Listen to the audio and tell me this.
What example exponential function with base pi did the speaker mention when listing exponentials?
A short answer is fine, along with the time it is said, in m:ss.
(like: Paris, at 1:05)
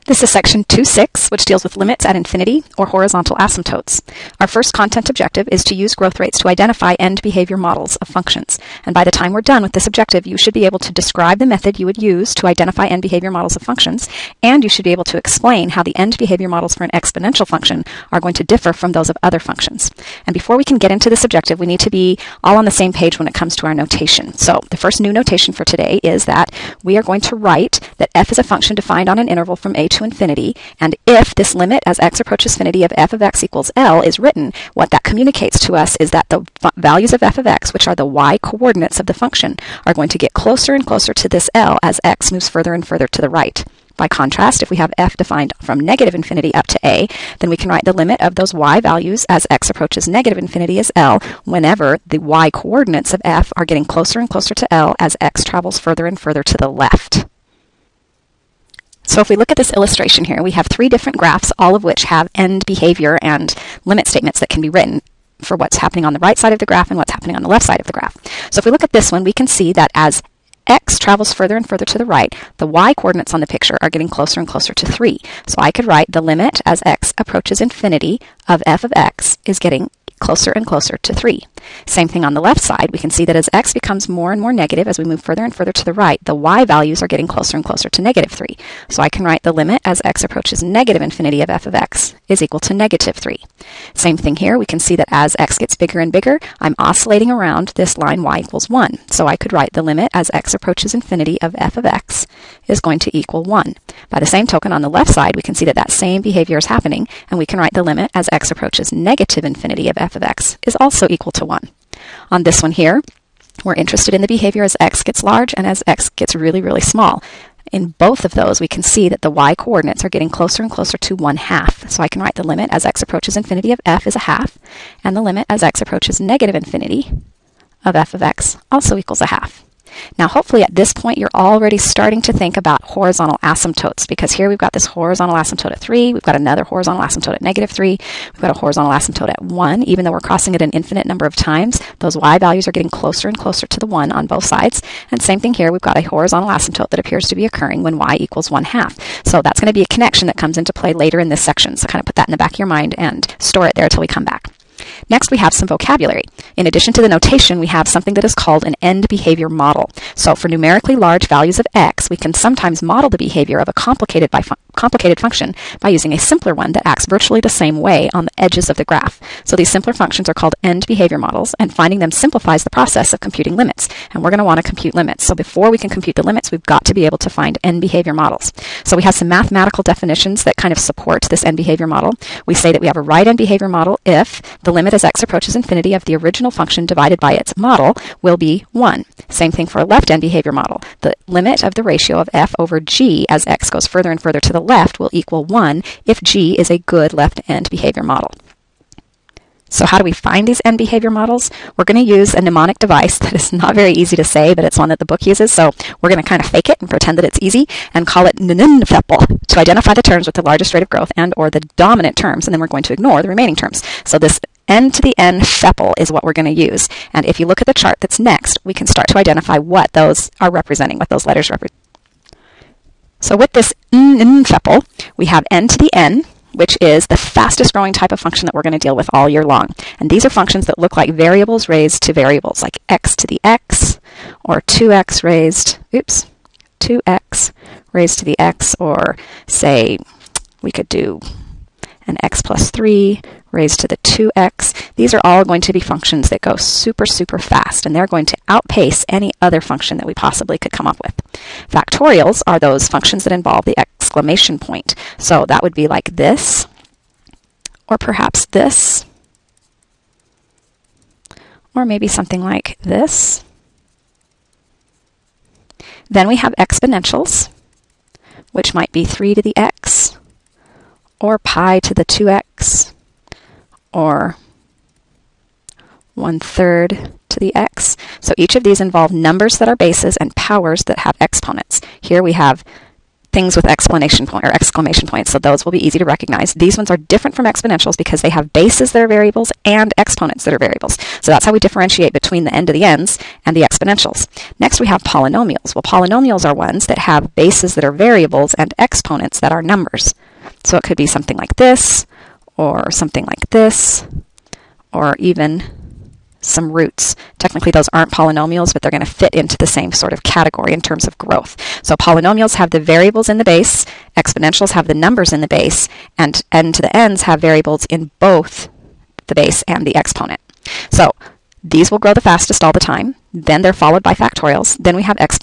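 pi to the 2x, at 4:31.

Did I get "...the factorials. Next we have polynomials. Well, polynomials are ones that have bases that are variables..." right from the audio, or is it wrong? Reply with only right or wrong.
wrong.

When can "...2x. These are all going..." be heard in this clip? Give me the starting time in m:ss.
4:04.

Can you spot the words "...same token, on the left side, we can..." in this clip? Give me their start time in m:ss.
1:44.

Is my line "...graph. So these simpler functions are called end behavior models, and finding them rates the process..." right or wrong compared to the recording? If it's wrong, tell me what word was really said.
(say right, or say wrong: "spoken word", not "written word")
wrong: "simplifies", not "rates".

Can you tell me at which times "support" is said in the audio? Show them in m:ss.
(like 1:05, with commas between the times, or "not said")
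3:00.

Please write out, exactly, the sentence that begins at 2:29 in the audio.
So that's going to be a connection that comes into play later later in this section.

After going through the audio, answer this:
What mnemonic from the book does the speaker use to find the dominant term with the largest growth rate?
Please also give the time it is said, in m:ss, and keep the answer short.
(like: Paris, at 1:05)
NNFEPL, at 3:28.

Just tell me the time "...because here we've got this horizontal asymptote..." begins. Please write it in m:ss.
2:14.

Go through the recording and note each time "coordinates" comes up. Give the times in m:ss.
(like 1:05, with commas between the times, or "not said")
0:38, 0:52, 1:12, 1:59.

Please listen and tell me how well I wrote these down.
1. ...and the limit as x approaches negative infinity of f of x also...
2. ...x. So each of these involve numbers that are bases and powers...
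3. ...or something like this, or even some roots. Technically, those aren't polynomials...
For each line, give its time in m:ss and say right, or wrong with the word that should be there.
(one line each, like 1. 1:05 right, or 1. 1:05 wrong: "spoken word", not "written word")
1. 2:05 right
2. 4:37 right
3. 5:02 right.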